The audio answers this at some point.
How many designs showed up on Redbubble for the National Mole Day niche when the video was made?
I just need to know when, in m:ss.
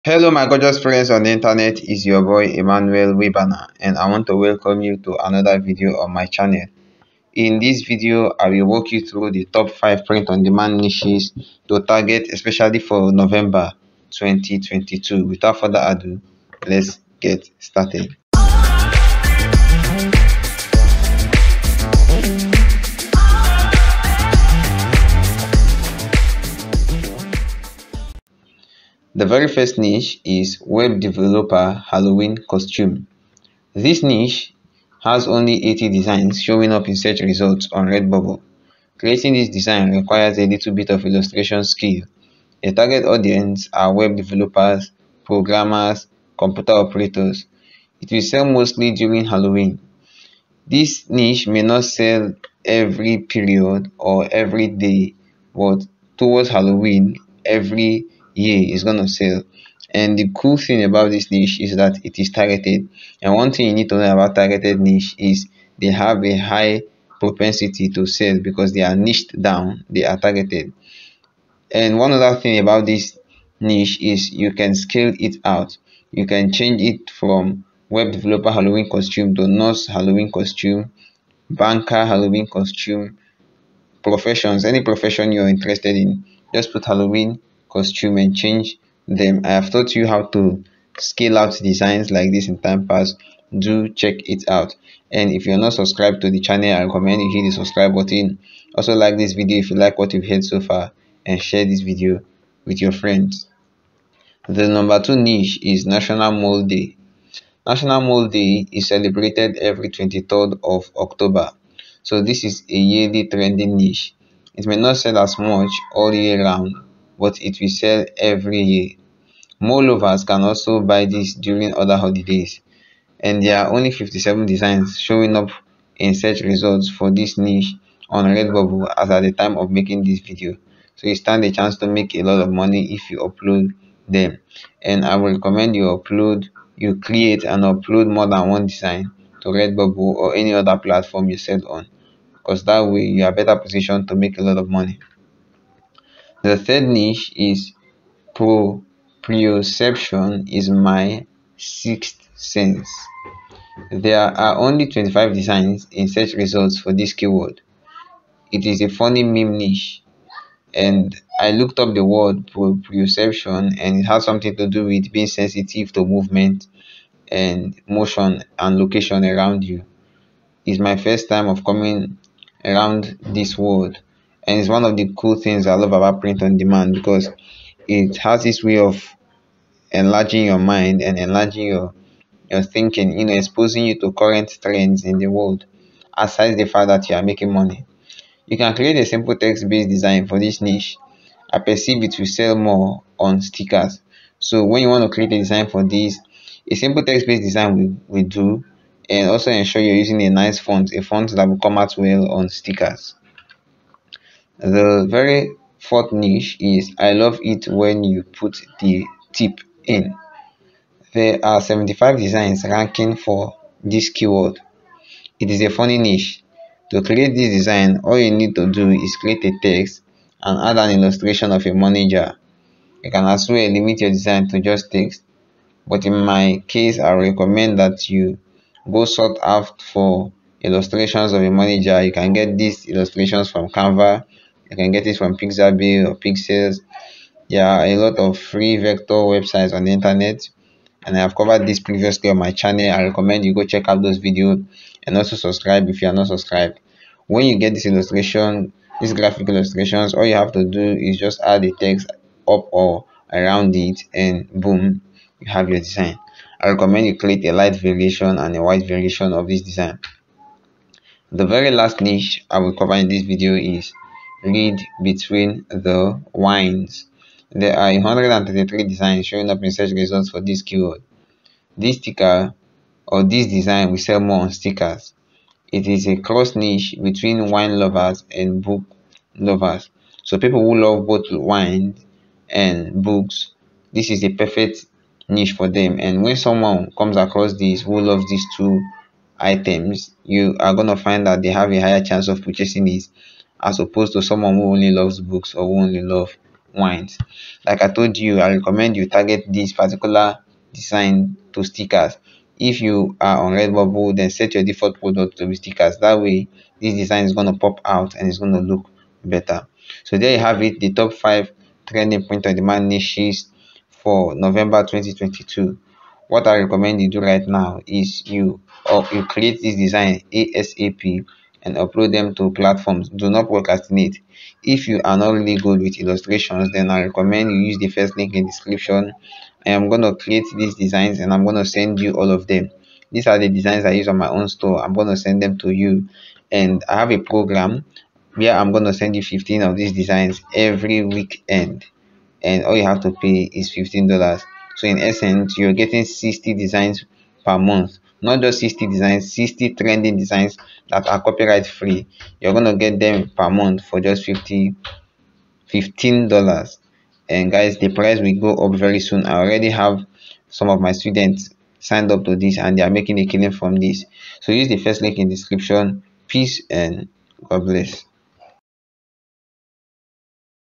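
2:03.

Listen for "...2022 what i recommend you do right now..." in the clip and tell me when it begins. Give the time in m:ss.
5:14.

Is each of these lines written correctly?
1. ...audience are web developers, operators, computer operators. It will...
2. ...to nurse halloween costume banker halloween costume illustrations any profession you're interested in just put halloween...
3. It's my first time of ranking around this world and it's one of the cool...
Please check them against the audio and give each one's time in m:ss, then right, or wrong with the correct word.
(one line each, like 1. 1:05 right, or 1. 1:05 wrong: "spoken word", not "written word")
1. 0:43 wrong: "programmers", not "operators"
2. 1:19 wrong: "professions", not "illustrations"
3. 2:50 wrong: "coming", not "ranking".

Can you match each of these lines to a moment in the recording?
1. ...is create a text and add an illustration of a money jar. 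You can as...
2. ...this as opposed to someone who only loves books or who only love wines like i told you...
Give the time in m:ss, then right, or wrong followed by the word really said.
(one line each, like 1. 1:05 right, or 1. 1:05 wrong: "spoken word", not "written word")
1. 3:38 right
2. 4:52 right.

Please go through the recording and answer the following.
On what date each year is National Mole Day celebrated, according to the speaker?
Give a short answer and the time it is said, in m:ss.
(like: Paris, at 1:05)
23rd of October, at 1:49.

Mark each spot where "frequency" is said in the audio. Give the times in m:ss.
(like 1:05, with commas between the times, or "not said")
not said.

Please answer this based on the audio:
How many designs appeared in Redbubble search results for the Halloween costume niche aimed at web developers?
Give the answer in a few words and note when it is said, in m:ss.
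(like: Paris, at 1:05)
80, at 0:35.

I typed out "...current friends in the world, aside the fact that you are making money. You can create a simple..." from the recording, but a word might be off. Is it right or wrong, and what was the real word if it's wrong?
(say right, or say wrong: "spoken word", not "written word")
wrong: "trends", not "friends".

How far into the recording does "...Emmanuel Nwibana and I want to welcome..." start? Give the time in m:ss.
0:02.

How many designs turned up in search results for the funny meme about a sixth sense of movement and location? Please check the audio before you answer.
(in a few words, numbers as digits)
25.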